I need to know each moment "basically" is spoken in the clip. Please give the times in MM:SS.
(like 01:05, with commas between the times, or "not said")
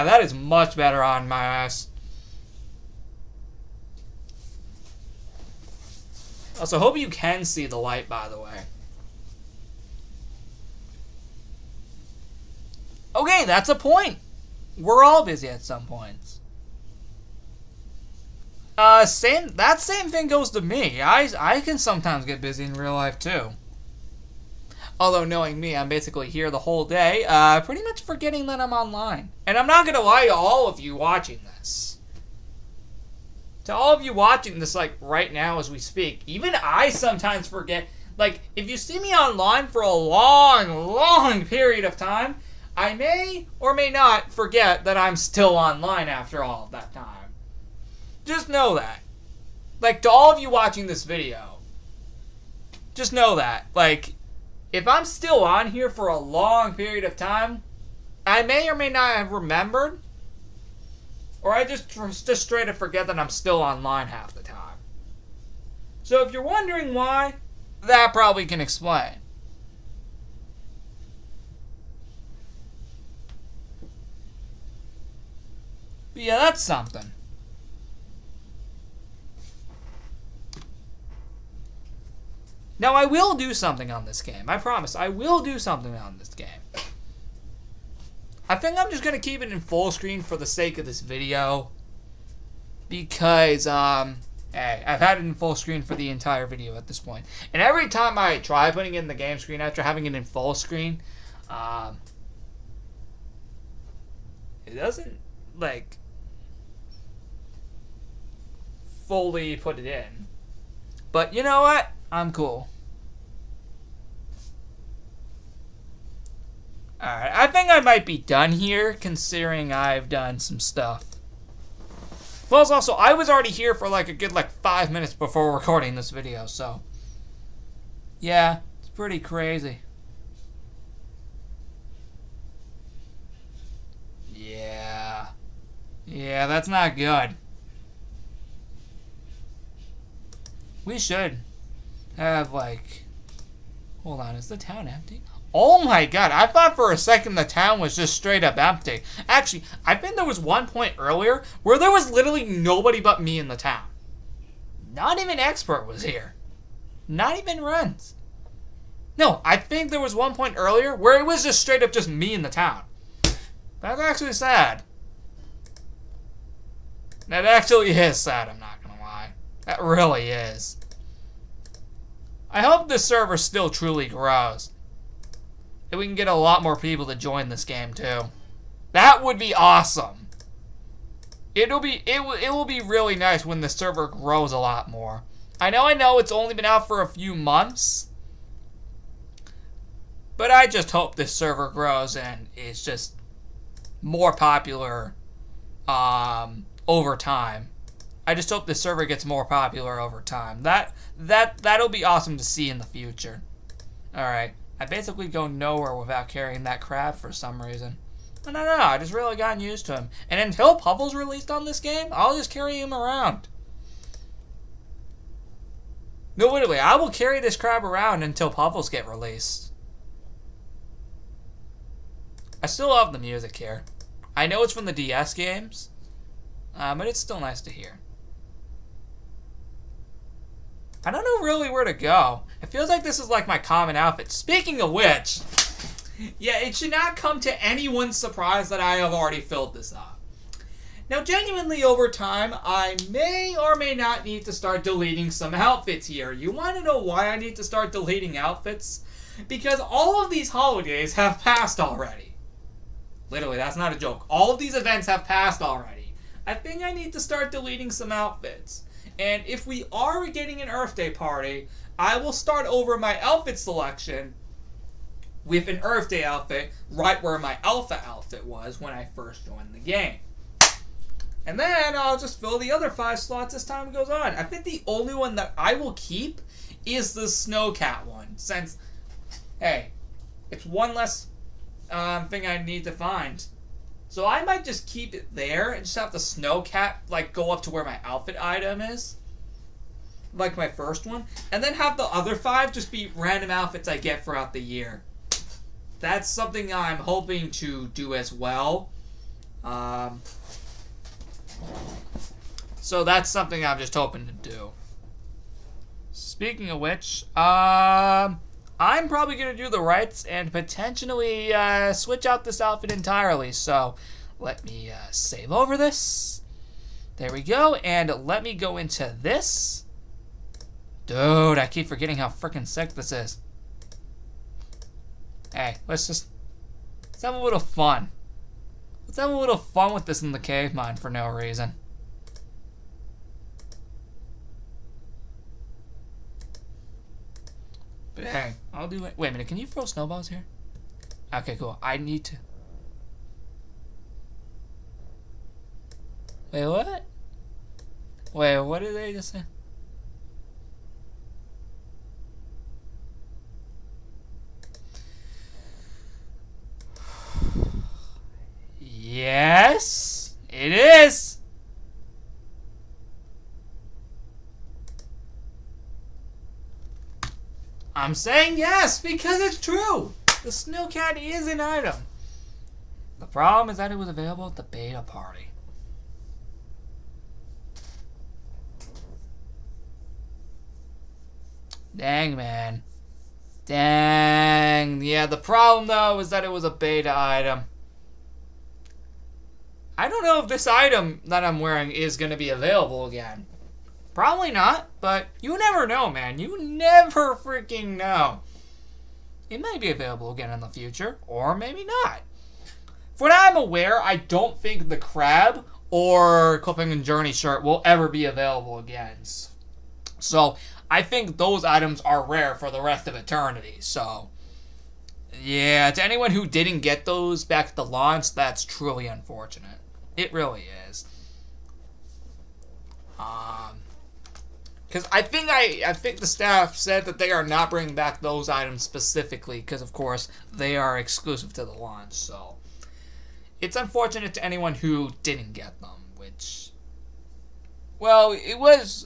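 00:25, 03:24.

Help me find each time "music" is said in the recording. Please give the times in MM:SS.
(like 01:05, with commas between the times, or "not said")
03:43.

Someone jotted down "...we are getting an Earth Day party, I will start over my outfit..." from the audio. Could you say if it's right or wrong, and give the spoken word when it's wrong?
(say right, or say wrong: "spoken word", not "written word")
right.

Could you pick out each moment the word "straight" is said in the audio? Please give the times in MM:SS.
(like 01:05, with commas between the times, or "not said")
01:02, 02:28, 02:41.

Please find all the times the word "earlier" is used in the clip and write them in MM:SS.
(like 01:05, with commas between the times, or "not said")
02:30, 02:40.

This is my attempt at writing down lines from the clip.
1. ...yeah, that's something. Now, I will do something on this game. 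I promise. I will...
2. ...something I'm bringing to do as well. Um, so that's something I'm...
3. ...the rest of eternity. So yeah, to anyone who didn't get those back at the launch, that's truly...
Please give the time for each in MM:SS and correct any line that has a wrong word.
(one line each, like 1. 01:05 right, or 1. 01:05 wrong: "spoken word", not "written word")
1. 01:16 right
2. 04:56 wrong: "hoping", not "bringing"
3. 06:52 right.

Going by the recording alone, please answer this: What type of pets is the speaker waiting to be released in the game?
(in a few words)
Puffles.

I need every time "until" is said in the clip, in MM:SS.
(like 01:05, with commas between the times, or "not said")
03:30, 03:38.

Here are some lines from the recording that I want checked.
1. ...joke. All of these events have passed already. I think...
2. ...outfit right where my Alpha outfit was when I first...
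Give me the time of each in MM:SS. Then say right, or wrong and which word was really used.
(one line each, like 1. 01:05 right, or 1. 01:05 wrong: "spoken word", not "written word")
1. 04:13 right
2. 04:26 right.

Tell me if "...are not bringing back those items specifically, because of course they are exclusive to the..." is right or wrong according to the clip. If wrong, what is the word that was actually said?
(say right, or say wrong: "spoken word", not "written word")
right.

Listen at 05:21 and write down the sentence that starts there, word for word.
Dude, I keep forgetting how freaking sick this is.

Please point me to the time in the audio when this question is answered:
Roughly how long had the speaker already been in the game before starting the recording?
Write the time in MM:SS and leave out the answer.
02:04.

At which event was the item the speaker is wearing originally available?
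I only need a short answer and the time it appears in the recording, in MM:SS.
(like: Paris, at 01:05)
beta party, at 06:14.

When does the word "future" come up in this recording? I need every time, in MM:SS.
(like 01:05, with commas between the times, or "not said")
03:22, 06:40.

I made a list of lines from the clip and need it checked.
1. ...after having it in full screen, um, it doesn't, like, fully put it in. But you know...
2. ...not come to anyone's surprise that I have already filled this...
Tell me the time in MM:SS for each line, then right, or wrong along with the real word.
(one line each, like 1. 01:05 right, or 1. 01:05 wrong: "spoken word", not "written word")
1. 01:39 right
2. 03:56 right.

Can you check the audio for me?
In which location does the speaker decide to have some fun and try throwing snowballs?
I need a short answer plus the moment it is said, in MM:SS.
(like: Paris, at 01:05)
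cave mine, at 05:30.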